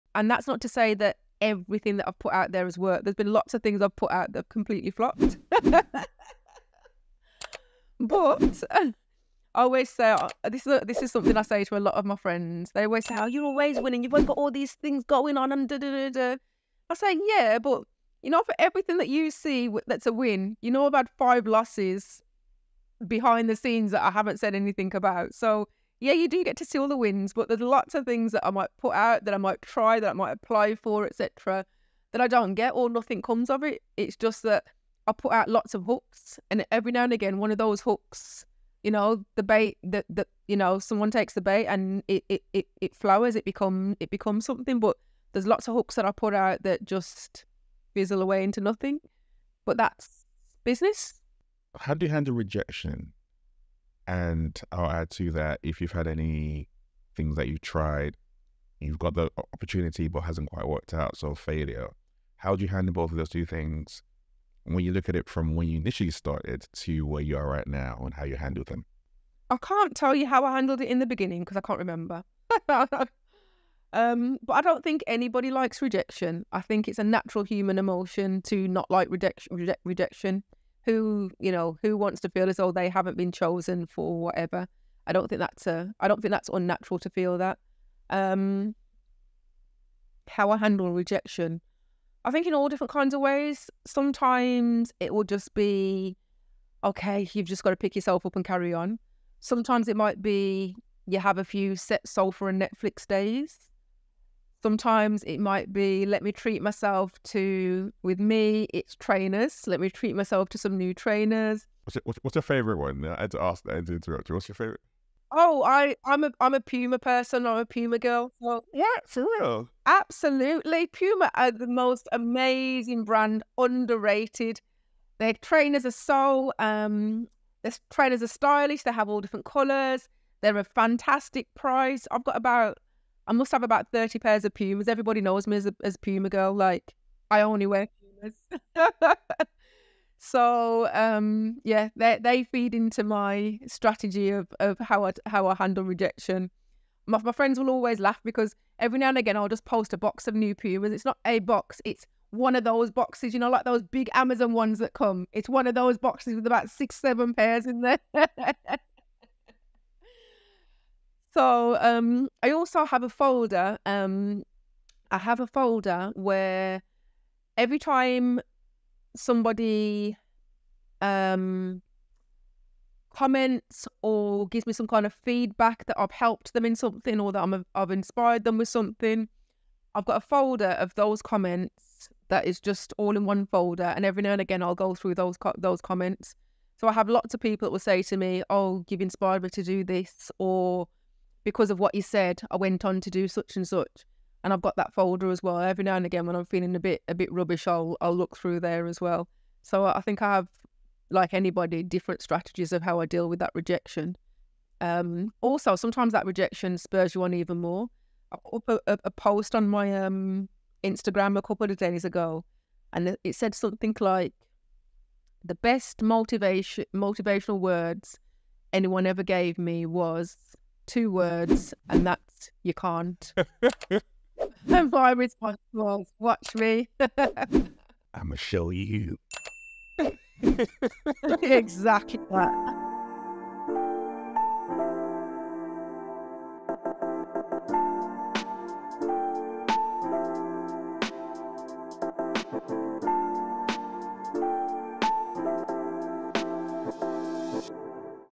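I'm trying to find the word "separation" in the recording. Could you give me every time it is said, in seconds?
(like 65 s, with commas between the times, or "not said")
not said.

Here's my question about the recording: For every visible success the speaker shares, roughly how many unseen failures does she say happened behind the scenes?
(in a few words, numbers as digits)
5.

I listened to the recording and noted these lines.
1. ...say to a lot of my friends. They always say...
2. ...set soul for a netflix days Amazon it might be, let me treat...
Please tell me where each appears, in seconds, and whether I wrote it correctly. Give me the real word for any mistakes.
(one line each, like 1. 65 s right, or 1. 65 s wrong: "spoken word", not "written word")
1. 11 s right
2. 101 s wrong: "Sometimes", not "Amazon".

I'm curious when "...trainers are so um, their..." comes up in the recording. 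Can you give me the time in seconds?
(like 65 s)
125 s.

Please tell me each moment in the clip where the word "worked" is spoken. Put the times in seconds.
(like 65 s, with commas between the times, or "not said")
2 s, 60 s.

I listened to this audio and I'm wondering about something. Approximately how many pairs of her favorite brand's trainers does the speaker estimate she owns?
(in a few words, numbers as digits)
30.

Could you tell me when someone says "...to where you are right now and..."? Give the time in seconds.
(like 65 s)
66 s.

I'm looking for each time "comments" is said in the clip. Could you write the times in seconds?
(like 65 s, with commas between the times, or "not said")
173 s, 181 s, 185 s.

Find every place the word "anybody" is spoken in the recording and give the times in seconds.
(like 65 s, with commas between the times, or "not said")
75 s, 201 s.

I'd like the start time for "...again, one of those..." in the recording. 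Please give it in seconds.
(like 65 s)
37 s.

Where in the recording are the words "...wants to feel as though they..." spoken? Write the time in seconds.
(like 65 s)
81 s.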